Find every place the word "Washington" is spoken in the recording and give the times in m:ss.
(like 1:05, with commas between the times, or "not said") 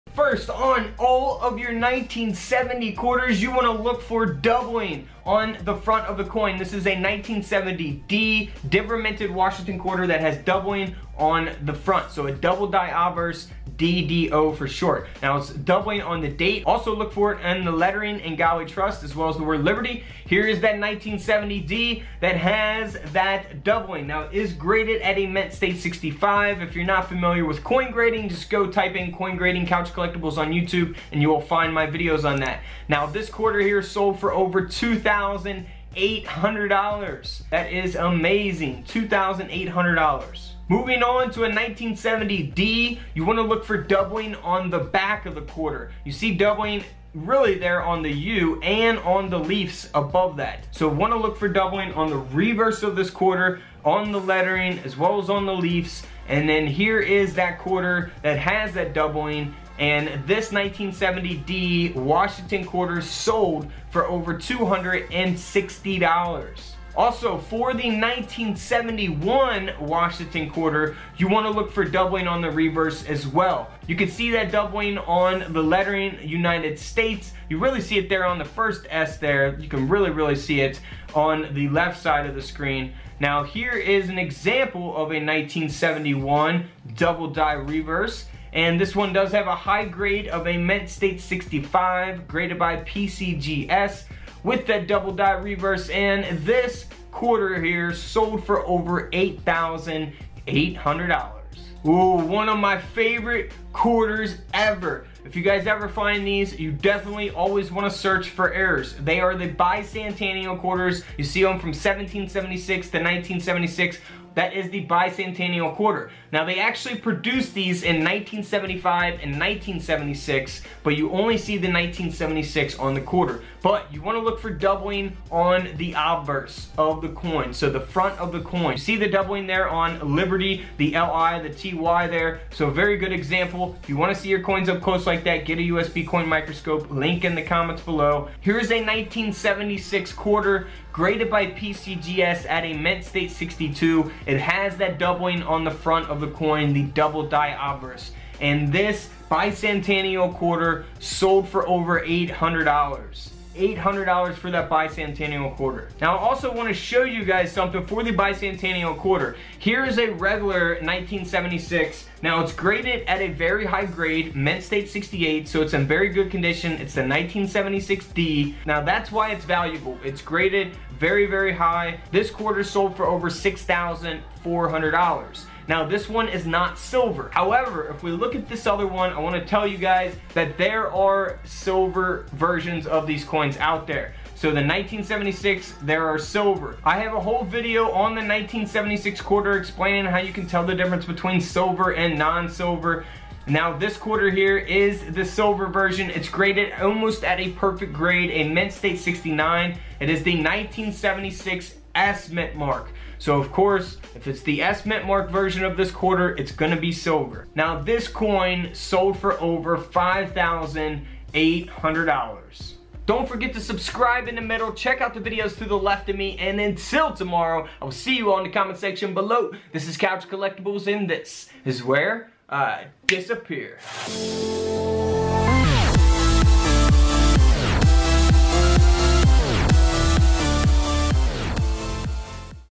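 0:09, 1:01, 1:09.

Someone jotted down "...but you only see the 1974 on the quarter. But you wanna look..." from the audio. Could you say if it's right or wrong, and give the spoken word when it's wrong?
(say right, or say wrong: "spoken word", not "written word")
wrong: "1976", not "1974".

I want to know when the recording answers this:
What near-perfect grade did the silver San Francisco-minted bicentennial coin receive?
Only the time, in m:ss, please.
3:18.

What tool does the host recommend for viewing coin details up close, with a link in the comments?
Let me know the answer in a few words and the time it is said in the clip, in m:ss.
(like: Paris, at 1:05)
USB coin microscope, at 2:15.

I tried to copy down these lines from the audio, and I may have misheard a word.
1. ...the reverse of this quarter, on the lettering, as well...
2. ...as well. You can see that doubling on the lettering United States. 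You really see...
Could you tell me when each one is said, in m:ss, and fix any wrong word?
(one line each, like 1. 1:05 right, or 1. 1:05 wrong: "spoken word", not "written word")
1. 0:52 right
2. 1:13 right.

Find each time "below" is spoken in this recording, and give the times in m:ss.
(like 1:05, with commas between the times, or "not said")
2:17, 3:39.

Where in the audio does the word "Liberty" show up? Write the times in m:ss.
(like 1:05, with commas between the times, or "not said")
0:19, 2:10.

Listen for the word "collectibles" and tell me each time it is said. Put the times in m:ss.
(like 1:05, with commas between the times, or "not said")
0:29, 3:40.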